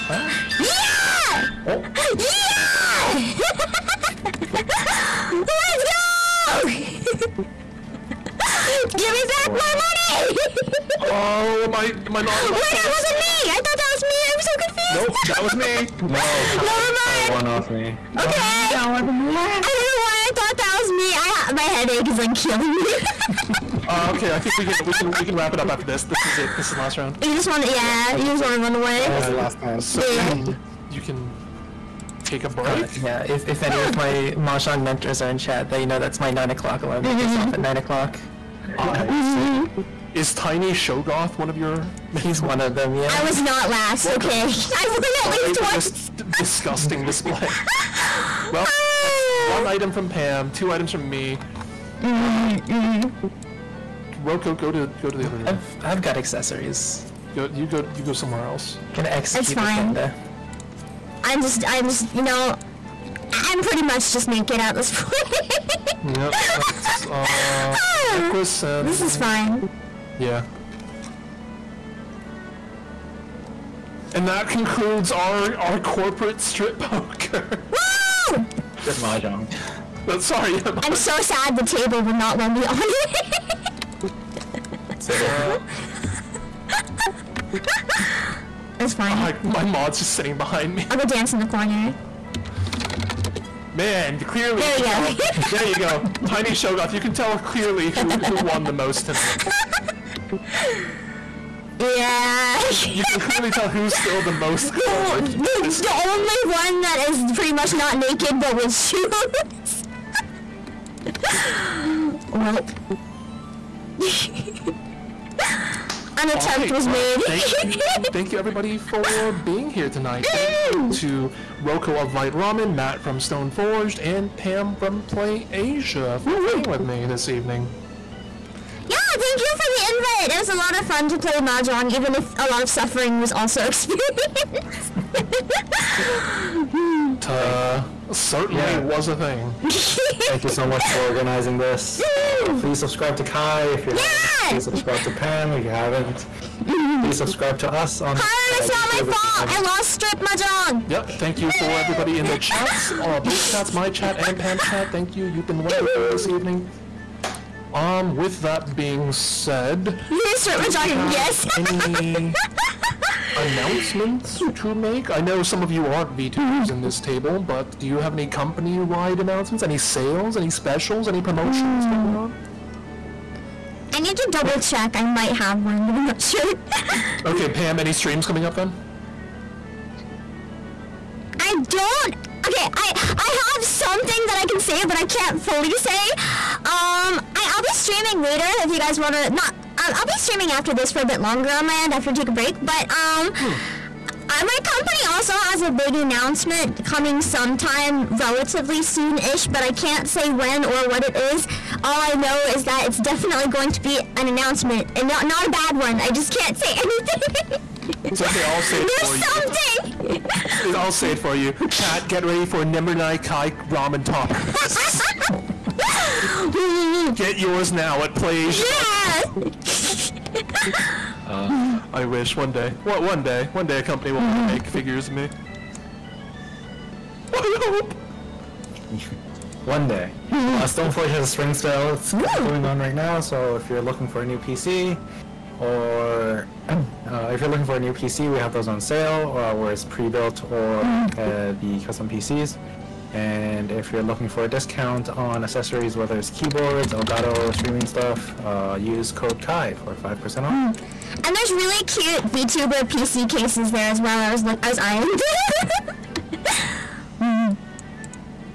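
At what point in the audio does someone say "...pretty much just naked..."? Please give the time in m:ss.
1:03.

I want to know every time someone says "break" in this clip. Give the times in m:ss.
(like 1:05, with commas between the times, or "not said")
0:32, 3:12.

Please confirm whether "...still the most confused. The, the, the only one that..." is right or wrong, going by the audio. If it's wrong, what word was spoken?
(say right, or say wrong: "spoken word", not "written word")
wrong: "clothed", not "confused".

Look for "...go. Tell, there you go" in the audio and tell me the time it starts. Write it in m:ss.
1:34.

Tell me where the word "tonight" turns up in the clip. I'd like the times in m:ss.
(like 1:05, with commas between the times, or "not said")
1:39, 1:59.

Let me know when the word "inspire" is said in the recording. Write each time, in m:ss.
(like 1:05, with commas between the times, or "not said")
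not said.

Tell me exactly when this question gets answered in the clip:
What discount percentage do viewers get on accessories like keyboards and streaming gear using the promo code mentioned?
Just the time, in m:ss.
4:09.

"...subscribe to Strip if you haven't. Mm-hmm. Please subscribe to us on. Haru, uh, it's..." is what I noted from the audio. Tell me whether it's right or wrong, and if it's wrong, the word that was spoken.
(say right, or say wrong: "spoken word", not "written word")
wrong: "Pam", not "Strip".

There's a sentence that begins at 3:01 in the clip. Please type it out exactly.
I don't okay, I I have something that I can say, but I can't fully say.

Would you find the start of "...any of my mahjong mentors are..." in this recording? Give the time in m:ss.
0:33.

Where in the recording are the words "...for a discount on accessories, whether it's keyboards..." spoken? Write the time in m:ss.
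4:04.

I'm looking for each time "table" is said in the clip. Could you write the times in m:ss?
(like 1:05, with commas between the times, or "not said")
1:21, 2:46.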